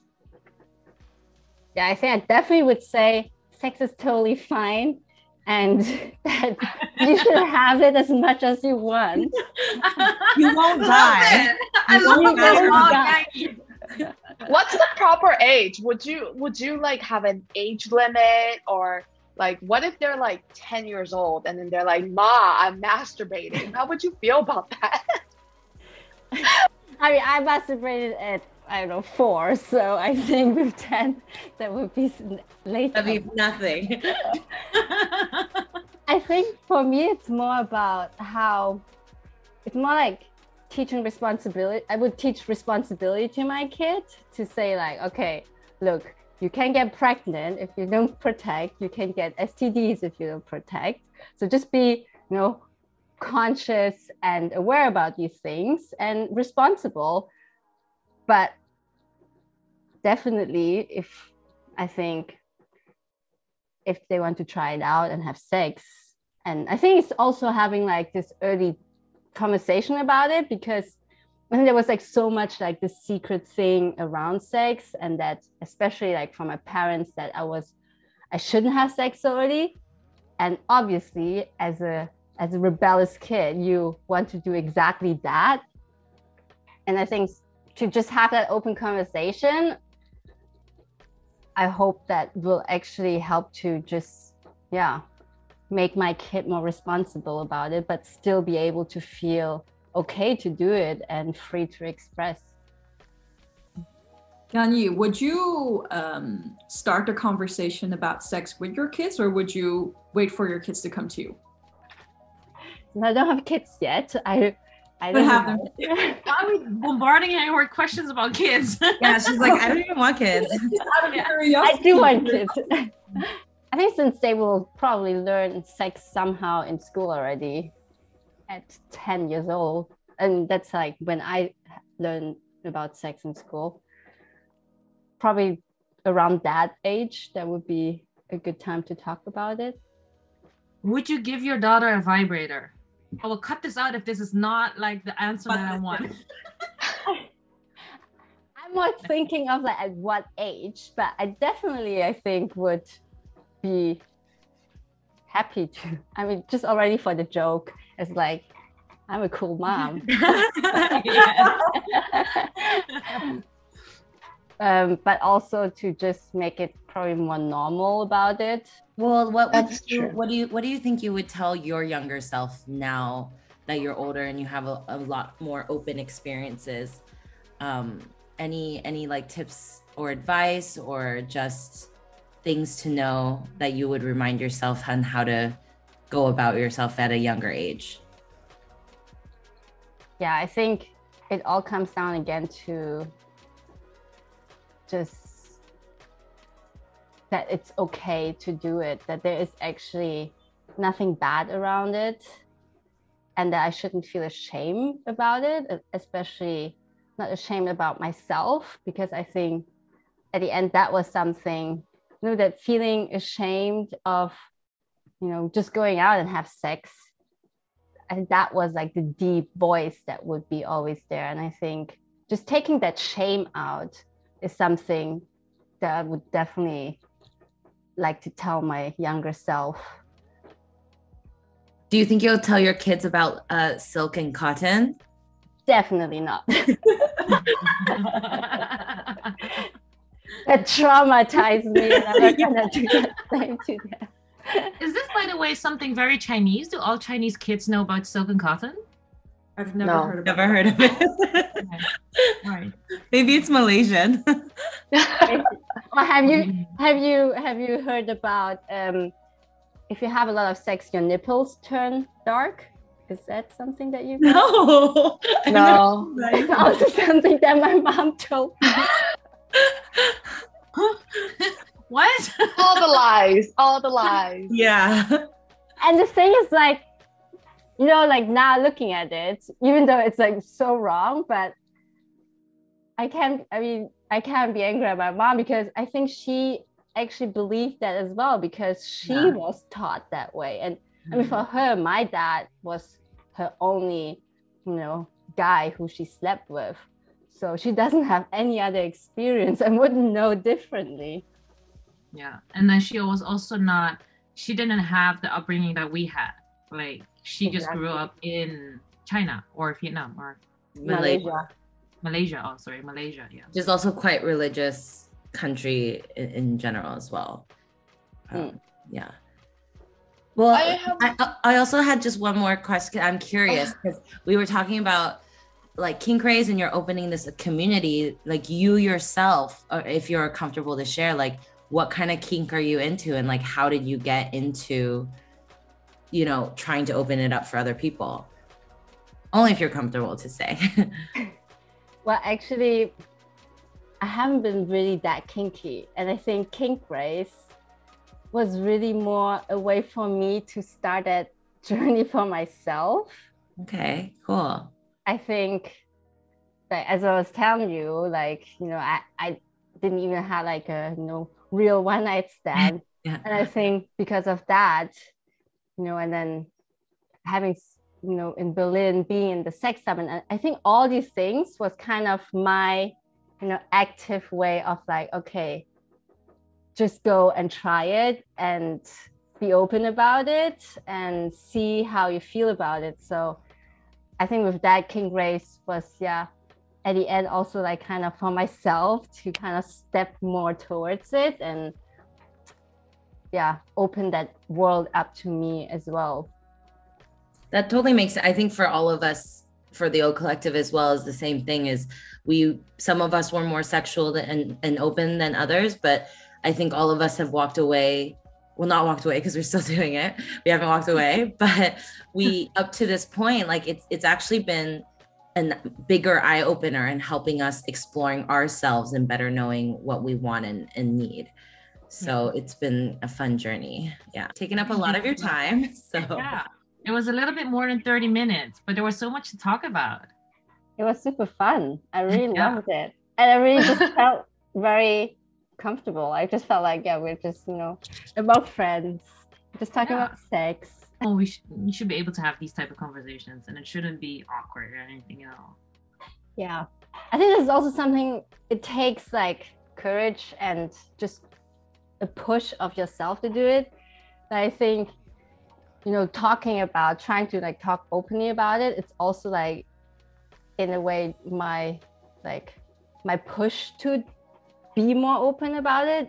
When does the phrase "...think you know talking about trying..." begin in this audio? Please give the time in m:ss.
7:34.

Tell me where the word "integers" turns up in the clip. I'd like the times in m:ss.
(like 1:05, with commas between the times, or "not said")
not said.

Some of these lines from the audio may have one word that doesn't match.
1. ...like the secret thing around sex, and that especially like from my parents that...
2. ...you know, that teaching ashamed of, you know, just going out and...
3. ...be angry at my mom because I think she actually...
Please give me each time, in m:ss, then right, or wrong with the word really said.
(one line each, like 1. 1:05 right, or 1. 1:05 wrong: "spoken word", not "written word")
1. 1:12 right
2. 3:32 wrong: "feeling", not "teaching"
3. 4:44 right.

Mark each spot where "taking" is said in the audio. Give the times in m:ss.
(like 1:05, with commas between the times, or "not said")
3:42, 7:04.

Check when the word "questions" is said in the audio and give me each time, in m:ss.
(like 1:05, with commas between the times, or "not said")
1:57, 5:22.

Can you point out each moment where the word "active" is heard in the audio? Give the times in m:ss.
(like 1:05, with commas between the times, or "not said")
6:13.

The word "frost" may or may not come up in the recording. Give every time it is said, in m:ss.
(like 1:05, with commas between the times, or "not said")
not said.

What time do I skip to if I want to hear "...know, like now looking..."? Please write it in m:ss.
4:37.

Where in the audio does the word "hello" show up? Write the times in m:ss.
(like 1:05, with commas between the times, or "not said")
not said.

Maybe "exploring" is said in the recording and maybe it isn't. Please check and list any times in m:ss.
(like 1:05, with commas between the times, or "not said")
6:57.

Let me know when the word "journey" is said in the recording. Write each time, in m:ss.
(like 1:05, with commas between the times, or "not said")
5:51, 7:03.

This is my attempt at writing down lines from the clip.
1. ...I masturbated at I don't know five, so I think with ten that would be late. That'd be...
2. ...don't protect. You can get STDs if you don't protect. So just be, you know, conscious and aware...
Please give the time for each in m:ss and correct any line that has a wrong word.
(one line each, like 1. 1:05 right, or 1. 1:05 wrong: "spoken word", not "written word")
1. 0:27 wrong: "four", not "five"
2. 0:47 right.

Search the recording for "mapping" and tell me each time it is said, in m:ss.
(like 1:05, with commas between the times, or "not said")
not said.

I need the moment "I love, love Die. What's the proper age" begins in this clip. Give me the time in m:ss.
0:11.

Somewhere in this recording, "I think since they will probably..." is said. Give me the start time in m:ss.
2:03.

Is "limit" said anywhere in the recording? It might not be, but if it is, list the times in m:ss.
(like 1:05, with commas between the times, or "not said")
0:17.